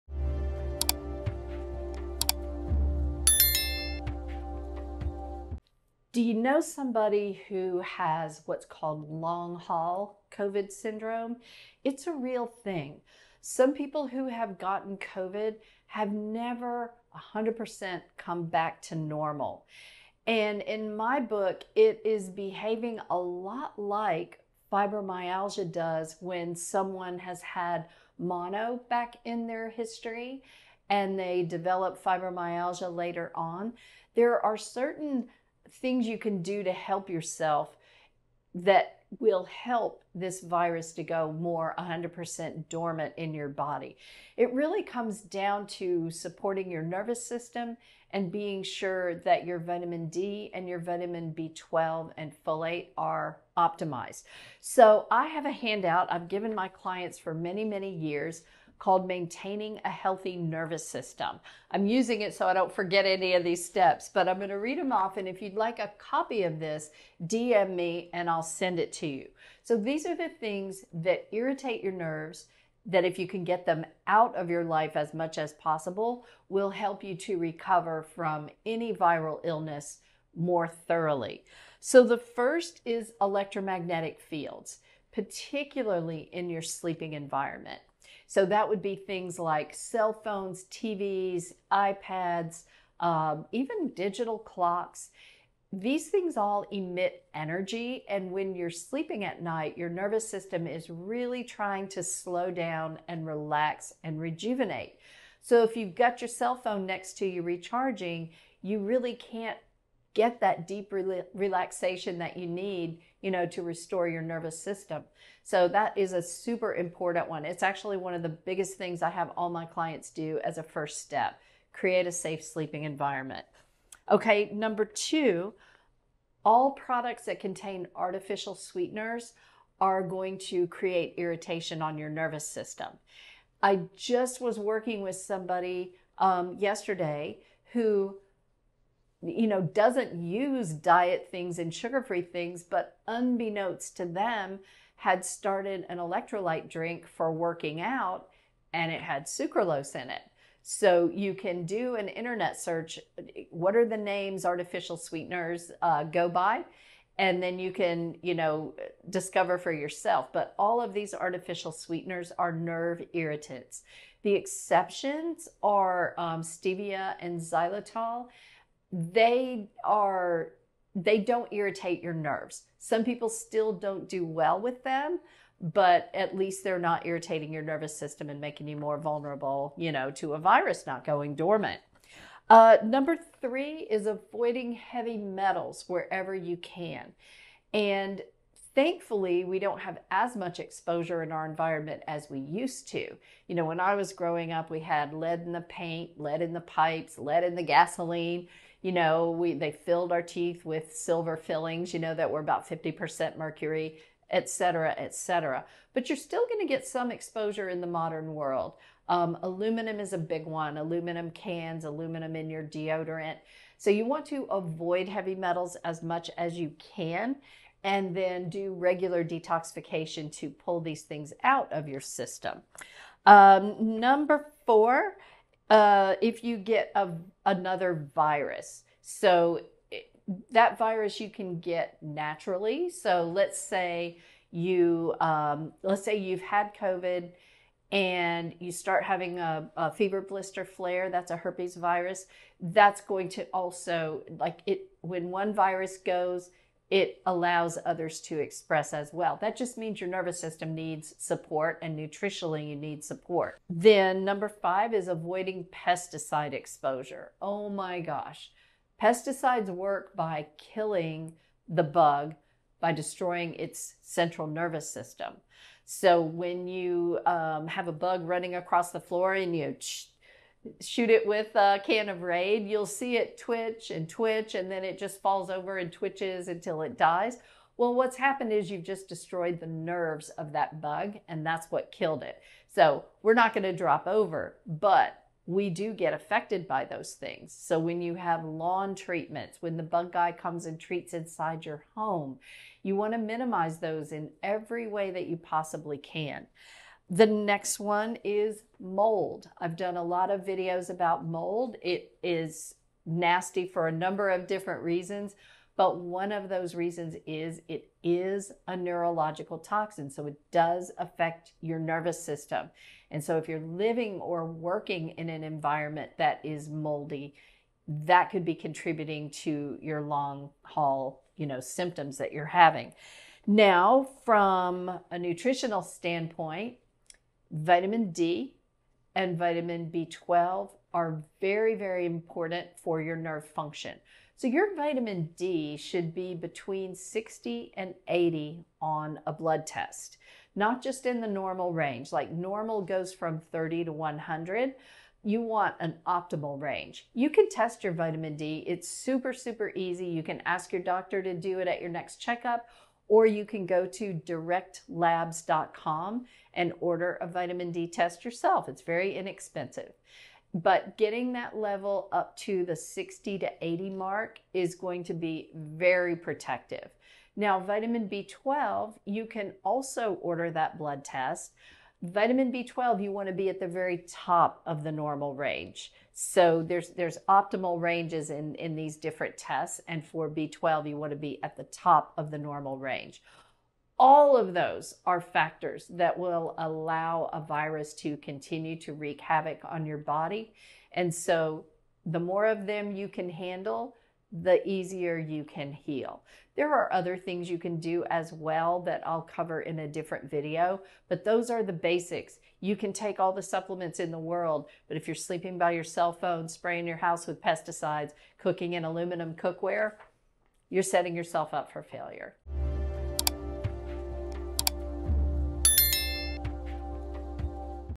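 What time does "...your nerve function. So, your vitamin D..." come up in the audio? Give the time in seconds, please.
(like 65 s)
333 s.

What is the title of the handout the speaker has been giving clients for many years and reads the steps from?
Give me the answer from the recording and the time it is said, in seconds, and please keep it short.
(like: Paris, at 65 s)
Maintaining a Healthy Nervous System, at 59 s.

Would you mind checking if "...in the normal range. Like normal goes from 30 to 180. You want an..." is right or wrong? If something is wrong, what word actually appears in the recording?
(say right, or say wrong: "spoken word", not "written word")
wrong: "100", not "180".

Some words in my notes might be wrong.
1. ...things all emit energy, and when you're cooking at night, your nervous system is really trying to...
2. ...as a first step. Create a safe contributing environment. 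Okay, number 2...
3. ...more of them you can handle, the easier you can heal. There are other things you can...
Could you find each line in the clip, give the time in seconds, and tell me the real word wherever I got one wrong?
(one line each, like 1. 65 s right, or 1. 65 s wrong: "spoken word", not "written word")
1. 96 s wrong: "sleeping", not "cooking"
2. 120 s wrong: "sleeping", not "contributing"
3. 392 s right.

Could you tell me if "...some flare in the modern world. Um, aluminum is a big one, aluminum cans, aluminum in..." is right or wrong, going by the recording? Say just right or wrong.
wrong.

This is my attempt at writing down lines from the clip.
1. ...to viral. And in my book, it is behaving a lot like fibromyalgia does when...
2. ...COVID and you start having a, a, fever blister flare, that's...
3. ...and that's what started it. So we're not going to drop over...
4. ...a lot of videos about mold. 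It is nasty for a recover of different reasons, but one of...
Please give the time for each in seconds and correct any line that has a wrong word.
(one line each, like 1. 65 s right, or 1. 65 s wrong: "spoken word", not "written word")
1. 18 s wrong: "normal", not "viral"
2. 236 s right
3. 281 s wrong: "killed", not "started"
4. 299 s wrong: "number", not "recover".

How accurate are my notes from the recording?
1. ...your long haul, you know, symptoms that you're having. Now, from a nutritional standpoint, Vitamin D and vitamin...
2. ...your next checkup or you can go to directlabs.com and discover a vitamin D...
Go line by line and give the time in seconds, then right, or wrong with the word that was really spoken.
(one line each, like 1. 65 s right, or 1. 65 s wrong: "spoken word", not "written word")
1. 319 s right
2. 351 s wrong: "order", not "discover".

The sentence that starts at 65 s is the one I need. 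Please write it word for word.
And if you'd like a copy of this, DM me and I'll send it to you.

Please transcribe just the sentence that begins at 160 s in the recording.
But all of these artificial sweeteners are nerve irritants.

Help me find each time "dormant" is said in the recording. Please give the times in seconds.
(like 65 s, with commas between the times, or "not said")
42 s, 181 s.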